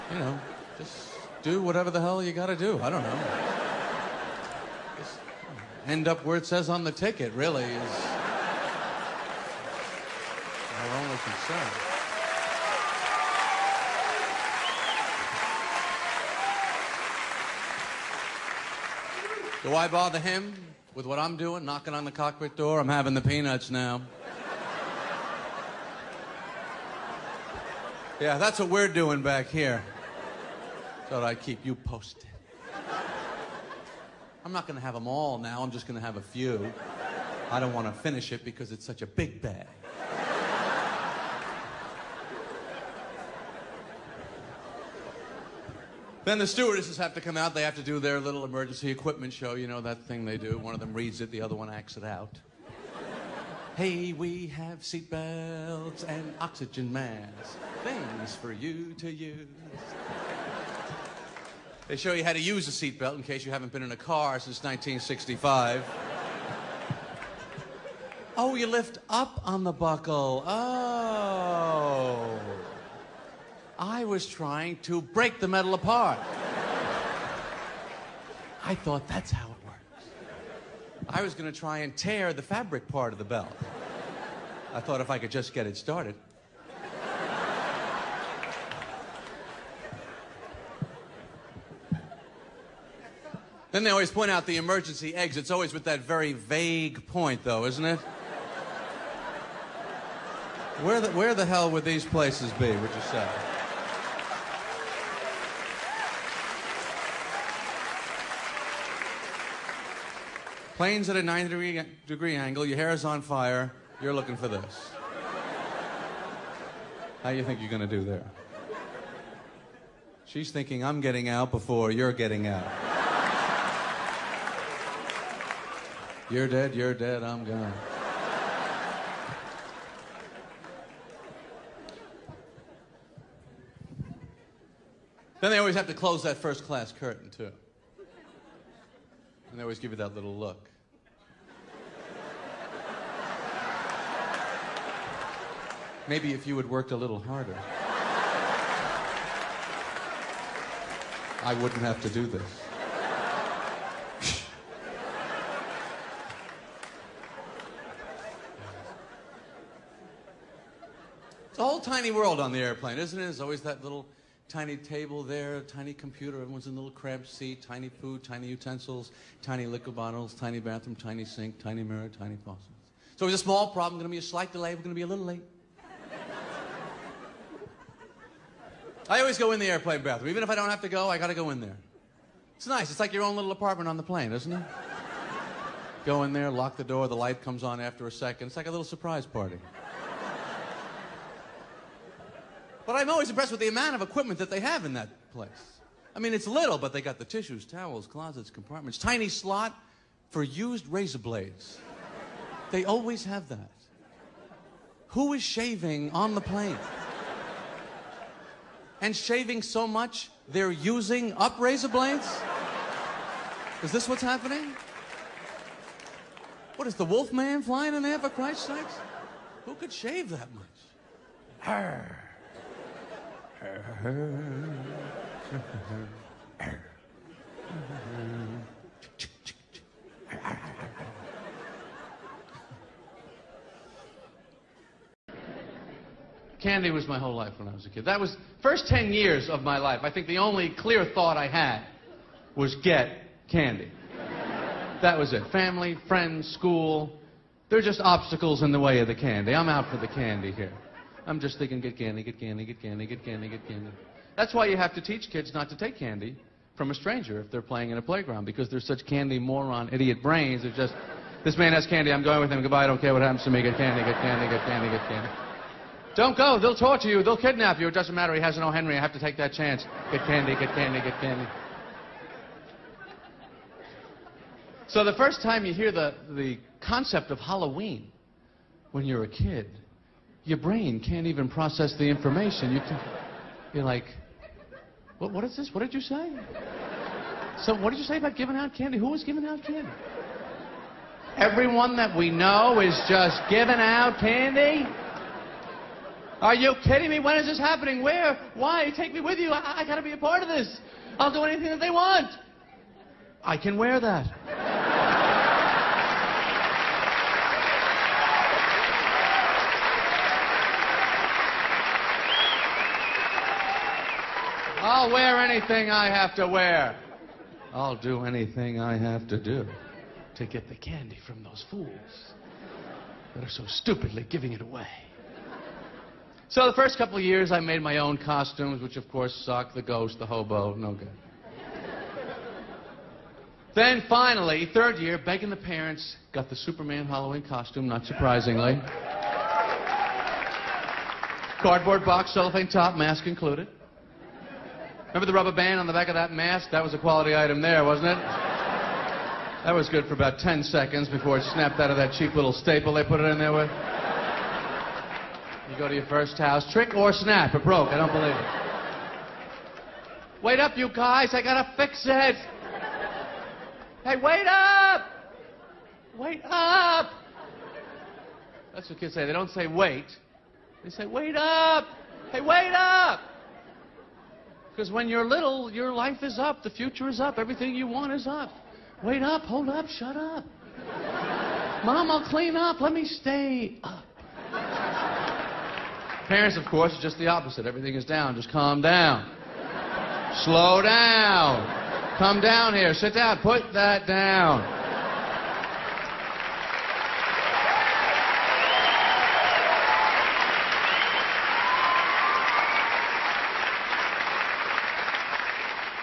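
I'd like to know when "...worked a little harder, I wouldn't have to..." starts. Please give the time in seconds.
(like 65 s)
146 s.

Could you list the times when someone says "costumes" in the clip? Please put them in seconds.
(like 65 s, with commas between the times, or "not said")
328 s, 337 s.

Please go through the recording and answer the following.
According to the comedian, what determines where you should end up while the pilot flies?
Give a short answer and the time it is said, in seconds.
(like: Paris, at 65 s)
the ticket, at 6 s.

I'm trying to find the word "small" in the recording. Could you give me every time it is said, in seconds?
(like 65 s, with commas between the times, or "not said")
173 s.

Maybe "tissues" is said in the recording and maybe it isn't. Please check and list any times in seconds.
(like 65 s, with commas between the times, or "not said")
197 s.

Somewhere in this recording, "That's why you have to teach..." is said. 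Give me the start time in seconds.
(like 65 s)
254 s.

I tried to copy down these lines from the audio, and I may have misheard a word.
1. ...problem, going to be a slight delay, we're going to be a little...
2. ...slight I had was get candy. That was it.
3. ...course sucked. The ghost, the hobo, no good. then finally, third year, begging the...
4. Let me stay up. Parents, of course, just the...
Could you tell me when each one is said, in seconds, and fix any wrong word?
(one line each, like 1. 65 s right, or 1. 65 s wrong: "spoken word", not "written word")
1. 173 s right
2. 241 s wrong: "thought", not "slight"
3. 329 s right
4. 382 s right.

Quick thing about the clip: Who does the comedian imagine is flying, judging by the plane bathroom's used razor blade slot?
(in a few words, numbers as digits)
the wolf man.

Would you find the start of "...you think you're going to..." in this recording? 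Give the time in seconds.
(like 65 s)
117 s.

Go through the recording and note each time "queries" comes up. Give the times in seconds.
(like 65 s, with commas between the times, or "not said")
not said.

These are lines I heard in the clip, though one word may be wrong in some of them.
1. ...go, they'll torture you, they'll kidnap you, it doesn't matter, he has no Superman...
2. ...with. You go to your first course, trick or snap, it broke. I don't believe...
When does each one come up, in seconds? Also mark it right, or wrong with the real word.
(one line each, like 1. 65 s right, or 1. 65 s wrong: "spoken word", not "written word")
1. 266 s wrong: "Henry", not "Superman"
2. 353 s wrong: "house", not "course".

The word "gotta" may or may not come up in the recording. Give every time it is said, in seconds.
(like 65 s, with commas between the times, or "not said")
299 s, 361 s.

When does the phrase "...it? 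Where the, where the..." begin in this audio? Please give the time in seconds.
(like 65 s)
97 s.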